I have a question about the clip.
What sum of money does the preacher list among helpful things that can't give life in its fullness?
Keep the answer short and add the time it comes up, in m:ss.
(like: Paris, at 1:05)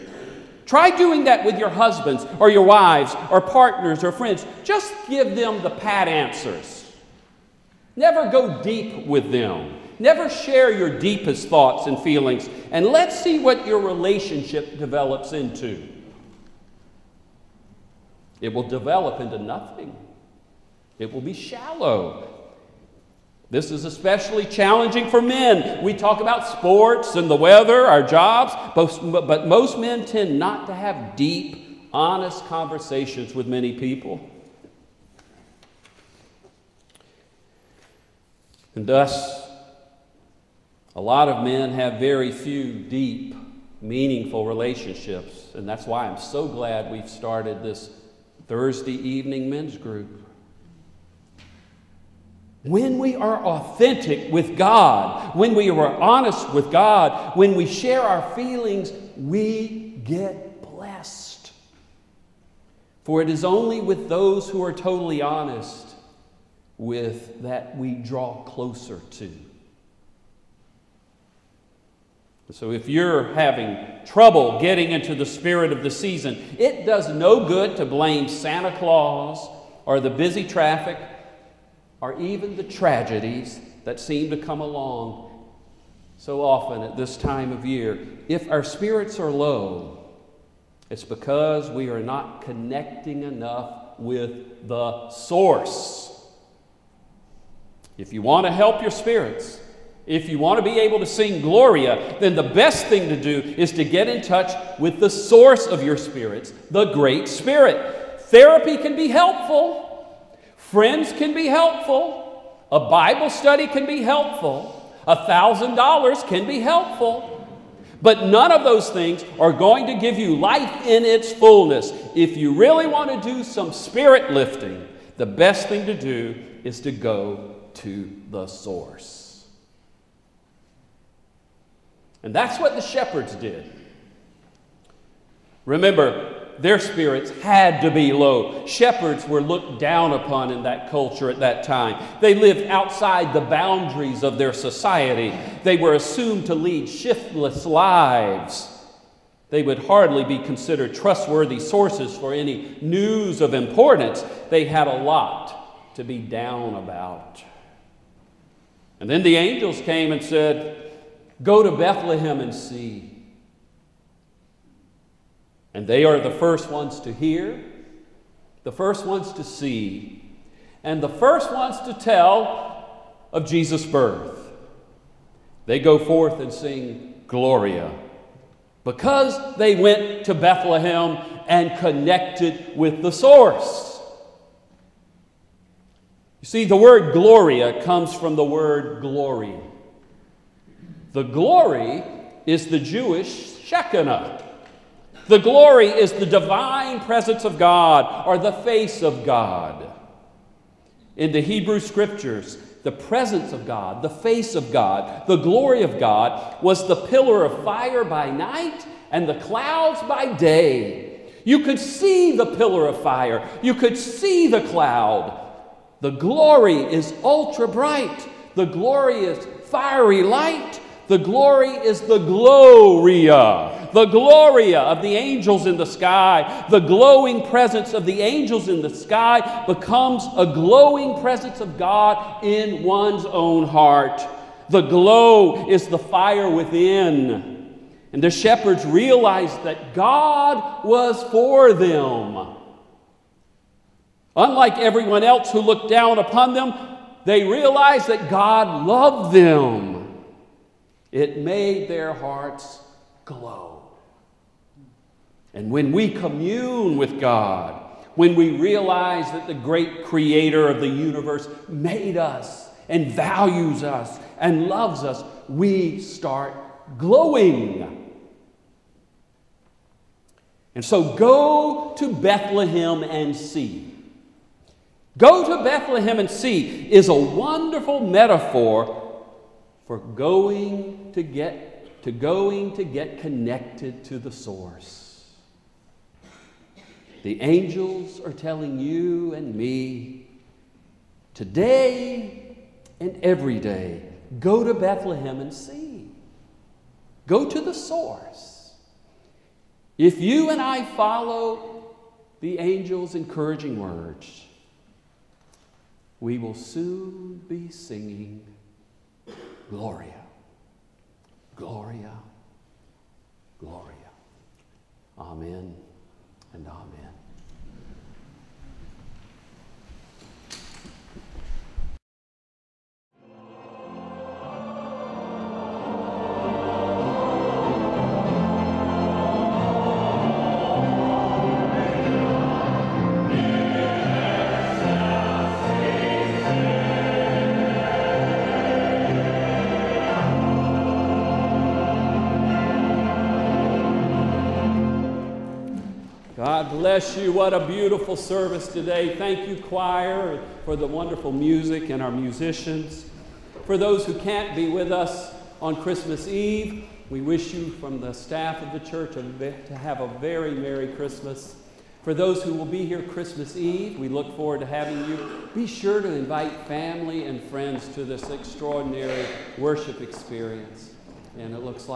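$1,000, at 1:55.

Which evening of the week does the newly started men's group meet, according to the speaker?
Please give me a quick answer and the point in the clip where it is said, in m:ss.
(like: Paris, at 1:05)
Thursday, at 0:48.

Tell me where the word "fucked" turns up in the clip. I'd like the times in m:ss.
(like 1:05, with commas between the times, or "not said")
not said.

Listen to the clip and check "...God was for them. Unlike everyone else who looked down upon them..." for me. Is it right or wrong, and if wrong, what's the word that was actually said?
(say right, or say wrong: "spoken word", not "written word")
right.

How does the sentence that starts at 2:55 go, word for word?
They go forth and sing Gloria because they went to Bethlehem and connected with the source.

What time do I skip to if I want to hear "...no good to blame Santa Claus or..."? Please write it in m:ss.
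1:17.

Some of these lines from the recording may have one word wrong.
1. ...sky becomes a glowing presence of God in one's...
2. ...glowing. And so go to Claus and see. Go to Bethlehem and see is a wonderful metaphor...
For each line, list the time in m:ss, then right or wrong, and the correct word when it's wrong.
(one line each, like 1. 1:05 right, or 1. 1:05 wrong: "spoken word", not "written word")
1. 3:48 right
2. 4:26 wrong: "Bethlehem", not "Claus".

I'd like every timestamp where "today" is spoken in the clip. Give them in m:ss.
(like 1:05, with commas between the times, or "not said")
4:51, 5:48.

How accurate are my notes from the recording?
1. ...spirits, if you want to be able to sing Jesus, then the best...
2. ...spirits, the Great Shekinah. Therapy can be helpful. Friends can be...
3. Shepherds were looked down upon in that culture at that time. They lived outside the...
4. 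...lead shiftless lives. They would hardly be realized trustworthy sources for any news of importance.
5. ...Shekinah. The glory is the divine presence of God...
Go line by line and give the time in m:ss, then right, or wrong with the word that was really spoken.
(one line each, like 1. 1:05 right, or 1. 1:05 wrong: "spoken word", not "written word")
1. 1:38 wrong: "Gloria", not "Jesus"
2. 1:45 wrong: "Spirit", not "Shekinah"
3. 2:18 right
4. 2:26 wrong: "considered", not "realized"
5. 3:13 right.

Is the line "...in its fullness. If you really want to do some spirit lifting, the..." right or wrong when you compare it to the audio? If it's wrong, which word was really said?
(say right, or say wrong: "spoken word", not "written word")
right.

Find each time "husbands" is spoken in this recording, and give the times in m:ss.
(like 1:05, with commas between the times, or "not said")
0:01.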